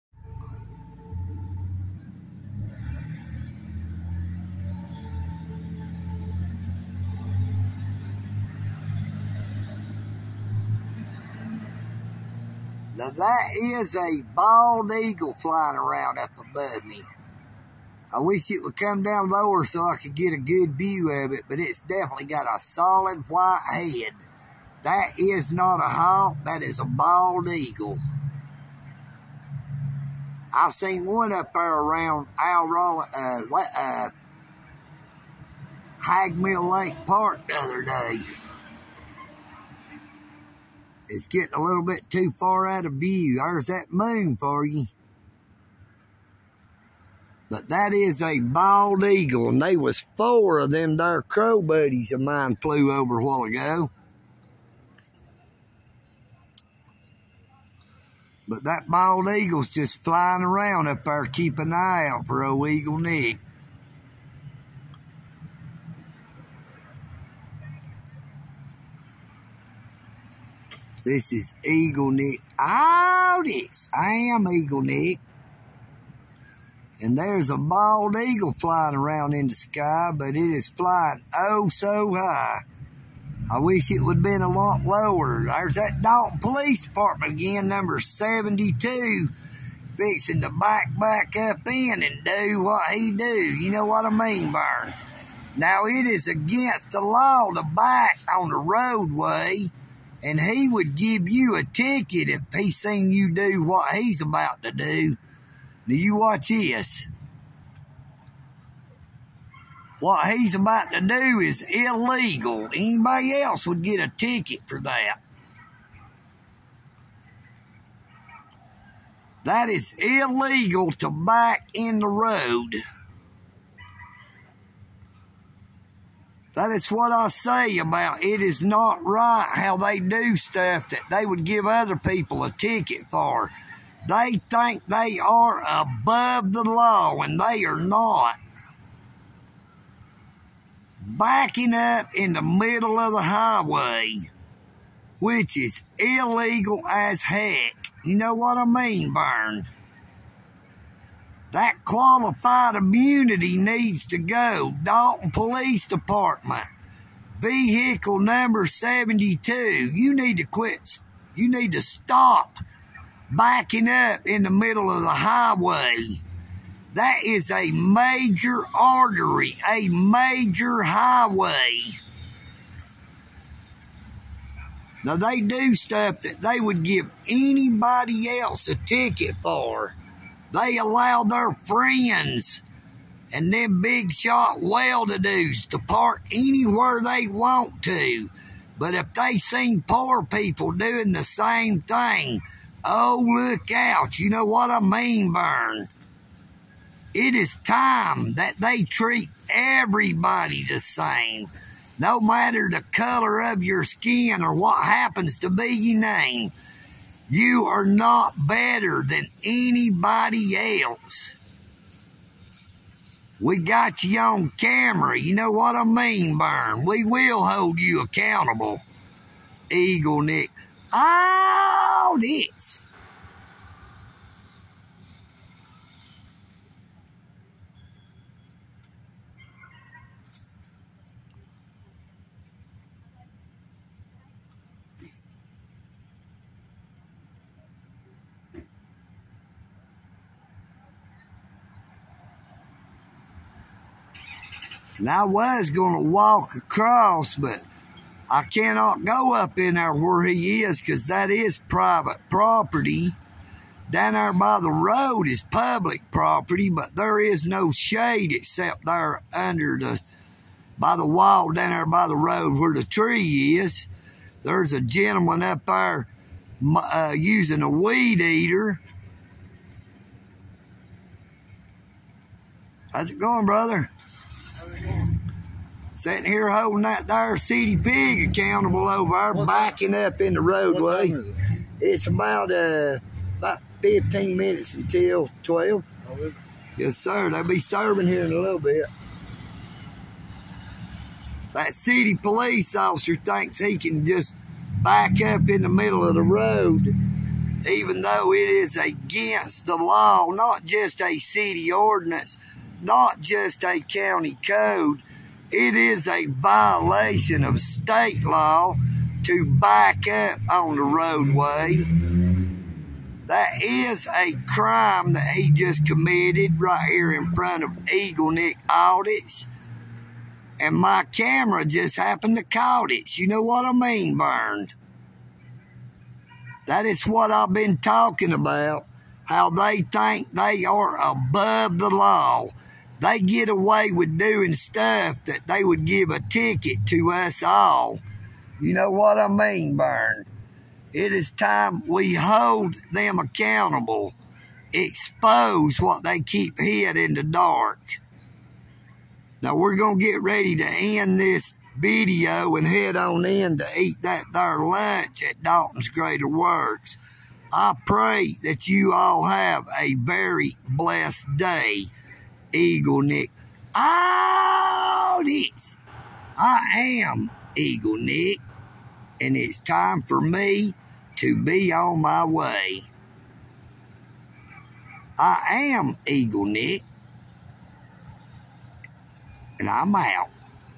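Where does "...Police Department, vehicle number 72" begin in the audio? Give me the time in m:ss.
2:35.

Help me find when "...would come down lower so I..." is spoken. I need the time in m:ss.
0:18.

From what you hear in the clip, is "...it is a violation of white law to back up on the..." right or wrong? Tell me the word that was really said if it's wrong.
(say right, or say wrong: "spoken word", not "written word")
wrong: "state", not "white".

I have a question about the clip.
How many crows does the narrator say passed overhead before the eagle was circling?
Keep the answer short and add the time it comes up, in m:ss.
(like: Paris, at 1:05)
4, at 0:50.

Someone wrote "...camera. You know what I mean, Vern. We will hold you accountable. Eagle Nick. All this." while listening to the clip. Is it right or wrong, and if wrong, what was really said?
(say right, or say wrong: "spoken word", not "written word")
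right.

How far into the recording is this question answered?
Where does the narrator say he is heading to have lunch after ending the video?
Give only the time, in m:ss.
5:55.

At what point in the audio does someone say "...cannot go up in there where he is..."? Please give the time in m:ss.
4:08.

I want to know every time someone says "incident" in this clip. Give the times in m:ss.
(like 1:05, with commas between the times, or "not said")
not said.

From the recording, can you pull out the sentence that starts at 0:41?
It's getting a little bit too far out of view.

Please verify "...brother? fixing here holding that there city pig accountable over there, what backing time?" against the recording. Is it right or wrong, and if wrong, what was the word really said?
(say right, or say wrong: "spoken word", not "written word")
wrong: "sitting", not "fixing".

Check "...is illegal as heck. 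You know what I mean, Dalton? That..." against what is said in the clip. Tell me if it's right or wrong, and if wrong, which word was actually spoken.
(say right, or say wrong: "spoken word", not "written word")
wrong: "Vern", not "Dalton".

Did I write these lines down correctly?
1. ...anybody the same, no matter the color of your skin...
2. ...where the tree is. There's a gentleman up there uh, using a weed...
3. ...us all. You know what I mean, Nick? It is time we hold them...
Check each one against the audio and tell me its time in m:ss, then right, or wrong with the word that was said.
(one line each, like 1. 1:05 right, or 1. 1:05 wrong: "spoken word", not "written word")
1. 3:19 wrong: "everybody", not "anybody"
2. 4:22 right
3. 5:37 wrong: "Vern", not "Nick".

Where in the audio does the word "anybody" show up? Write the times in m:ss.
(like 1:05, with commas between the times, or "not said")
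1:52, 2:57, 3:29.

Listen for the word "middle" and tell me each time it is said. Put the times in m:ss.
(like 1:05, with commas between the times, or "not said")
2:22, 2:44, 4:55.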